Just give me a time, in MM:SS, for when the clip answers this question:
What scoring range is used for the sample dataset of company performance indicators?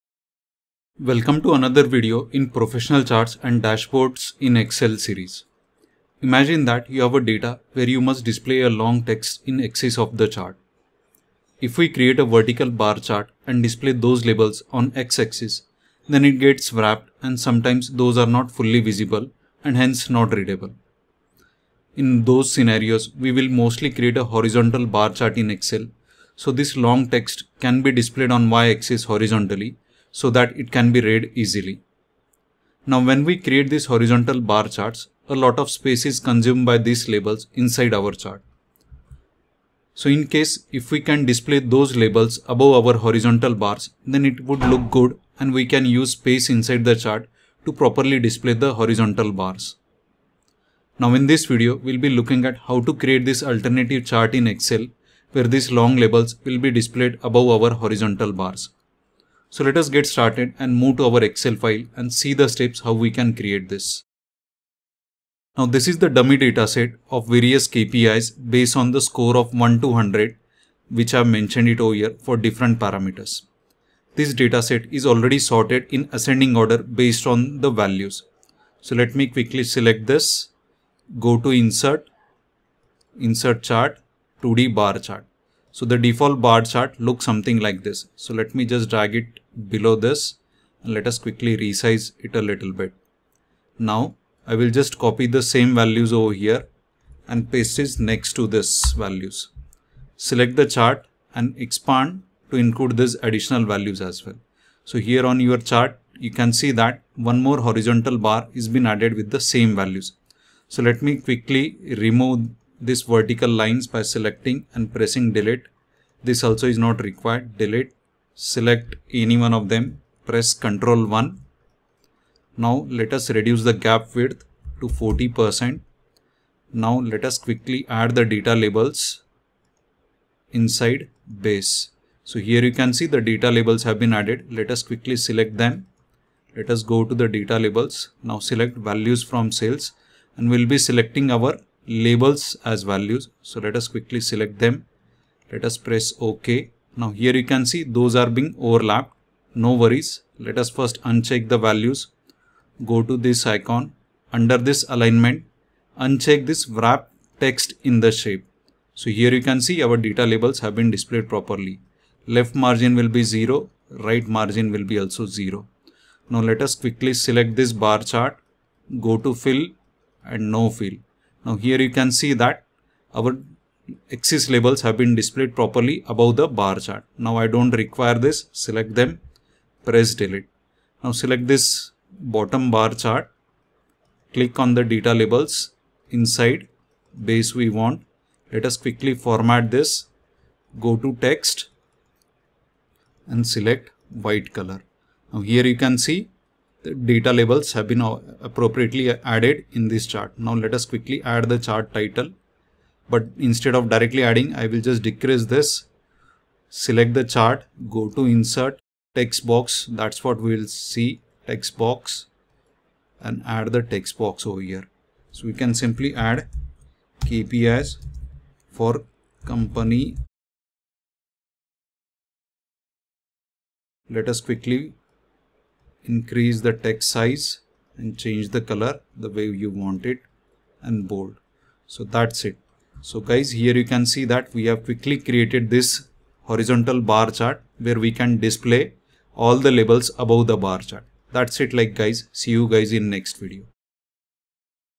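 01:09.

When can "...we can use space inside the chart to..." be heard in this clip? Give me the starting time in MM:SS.
00:45.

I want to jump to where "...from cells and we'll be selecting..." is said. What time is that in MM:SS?
02:19.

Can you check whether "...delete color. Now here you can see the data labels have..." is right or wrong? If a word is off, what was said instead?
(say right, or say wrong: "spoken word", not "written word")
wrong: "white", not "delete".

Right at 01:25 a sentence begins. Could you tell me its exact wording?
So the default bar chart looks something like this.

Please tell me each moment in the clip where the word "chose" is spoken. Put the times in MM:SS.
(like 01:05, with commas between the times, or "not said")
not said.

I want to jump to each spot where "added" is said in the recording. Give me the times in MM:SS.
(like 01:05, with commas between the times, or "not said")
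01:48, 02:14, 03:19.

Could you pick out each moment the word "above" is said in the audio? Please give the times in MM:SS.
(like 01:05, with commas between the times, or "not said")
00:42, 00:57, 02:56, 04:00.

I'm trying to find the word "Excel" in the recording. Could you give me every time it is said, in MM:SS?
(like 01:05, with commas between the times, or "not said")
00:04, 00:25, 00:54, 01:01.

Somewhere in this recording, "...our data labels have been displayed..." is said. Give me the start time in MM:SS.
02:39.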